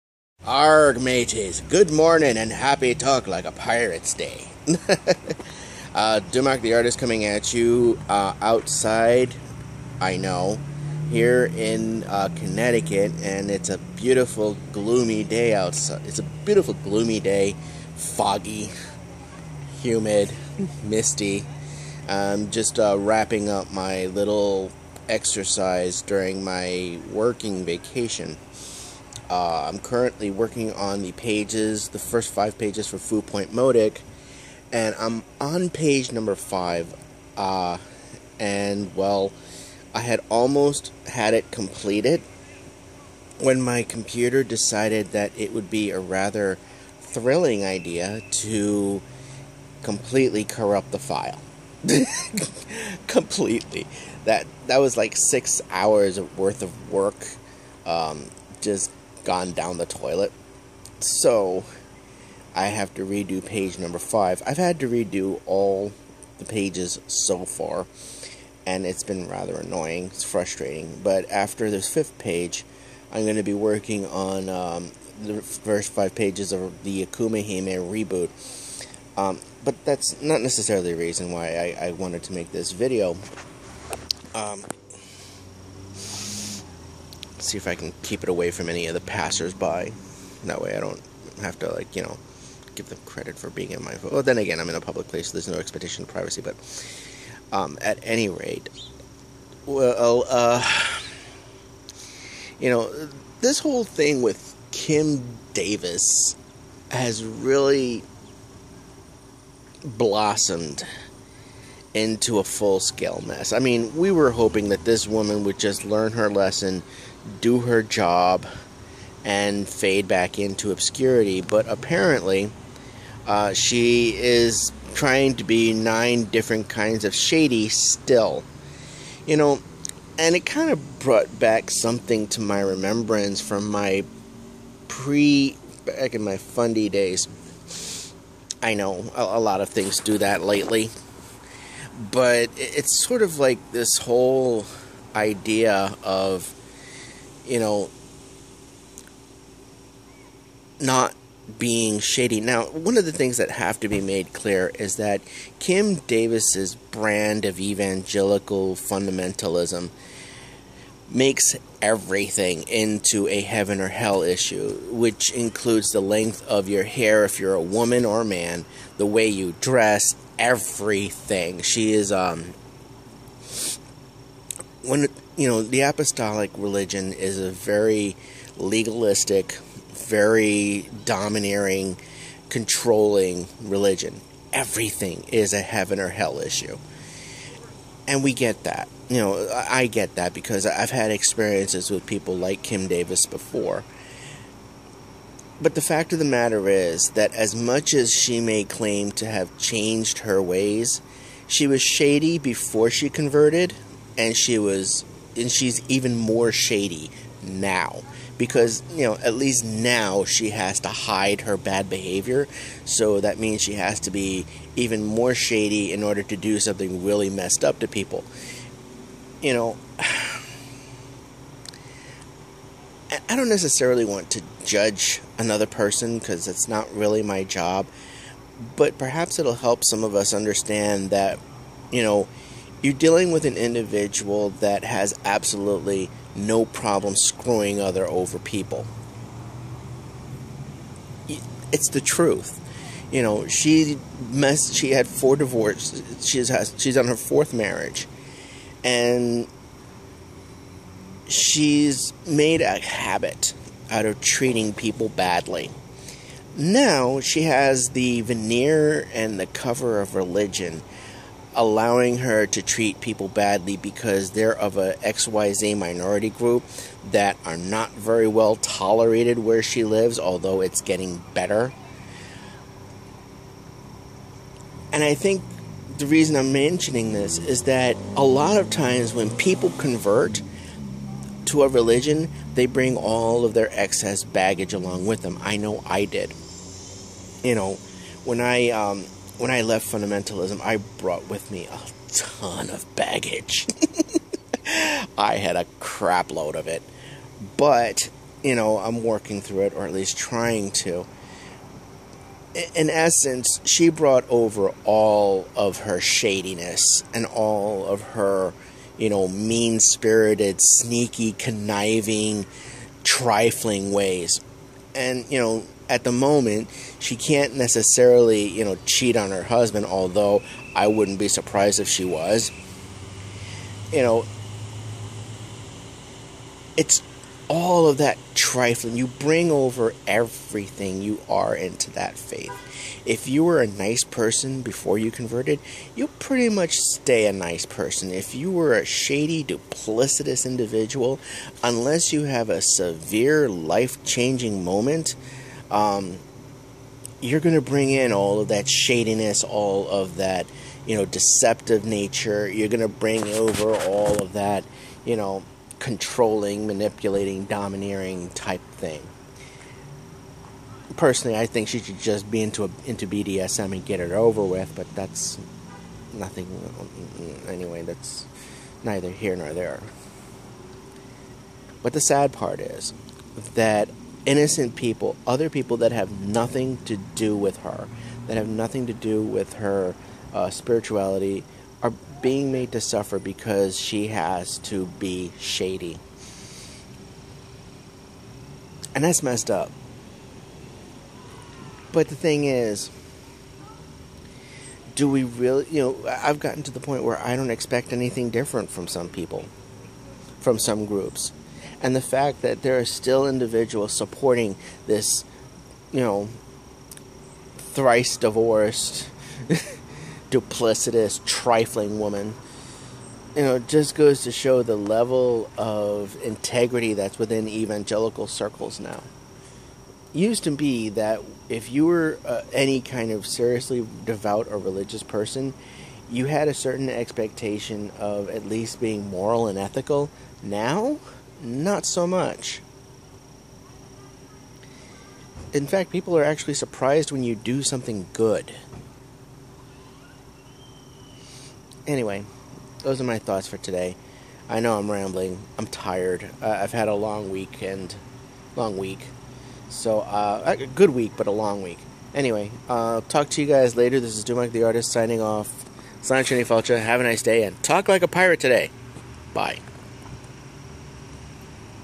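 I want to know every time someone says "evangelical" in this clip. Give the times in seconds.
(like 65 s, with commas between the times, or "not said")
157 s, 417 s.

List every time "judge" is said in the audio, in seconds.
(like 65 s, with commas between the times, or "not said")
224 s.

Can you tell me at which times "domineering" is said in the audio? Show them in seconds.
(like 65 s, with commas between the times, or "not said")
181 s, 357 s.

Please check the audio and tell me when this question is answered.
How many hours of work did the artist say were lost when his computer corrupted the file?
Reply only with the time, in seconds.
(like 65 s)
55 s.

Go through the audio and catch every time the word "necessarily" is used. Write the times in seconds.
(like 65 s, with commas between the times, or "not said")
80 s, 223 s, 317 s.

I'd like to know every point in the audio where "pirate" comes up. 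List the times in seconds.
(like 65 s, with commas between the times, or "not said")
3 s, 458 s.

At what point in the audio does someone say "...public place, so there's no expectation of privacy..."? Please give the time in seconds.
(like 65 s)
94 s.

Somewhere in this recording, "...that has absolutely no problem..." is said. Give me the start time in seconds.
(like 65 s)
234 s.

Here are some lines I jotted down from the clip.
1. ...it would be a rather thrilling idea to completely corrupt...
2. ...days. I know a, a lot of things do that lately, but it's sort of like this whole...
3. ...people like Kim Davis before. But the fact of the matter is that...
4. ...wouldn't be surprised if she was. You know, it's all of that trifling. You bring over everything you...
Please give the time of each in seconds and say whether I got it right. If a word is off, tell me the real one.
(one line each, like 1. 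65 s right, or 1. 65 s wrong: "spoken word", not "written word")
1. 45 s right
2. 136 s right
3. 192 s right
4. 320 s right.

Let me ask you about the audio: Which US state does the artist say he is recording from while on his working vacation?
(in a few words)
Connecticut.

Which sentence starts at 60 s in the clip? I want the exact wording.
So I have to redo page number five.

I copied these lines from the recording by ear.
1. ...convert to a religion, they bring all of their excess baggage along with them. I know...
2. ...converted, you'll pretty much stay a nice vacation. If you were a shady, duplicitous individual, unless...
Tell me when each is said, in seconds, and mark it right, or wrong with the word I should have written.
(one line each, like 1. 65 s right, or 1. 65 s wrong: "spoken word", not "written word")
1. 279 s right
2. 335 s wrong: "person", not "vacation".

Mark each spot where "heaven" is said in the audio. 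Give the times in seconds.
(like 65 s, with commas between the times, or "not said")
163 s, 185 s.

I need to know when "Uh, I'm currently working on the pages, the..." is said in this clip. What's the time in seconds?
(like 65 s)
29 s.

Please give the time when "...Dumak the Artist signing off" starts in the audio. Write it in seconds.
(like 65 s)
454 s.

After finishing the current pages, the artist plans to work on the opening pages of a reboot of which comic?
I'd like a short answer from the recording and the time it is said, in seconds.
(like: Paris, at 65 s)
Akuma Hime, at 77 s.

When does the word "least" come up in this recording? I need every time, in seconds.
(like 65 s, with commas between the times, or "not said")
209 s, 299 s, 428 s.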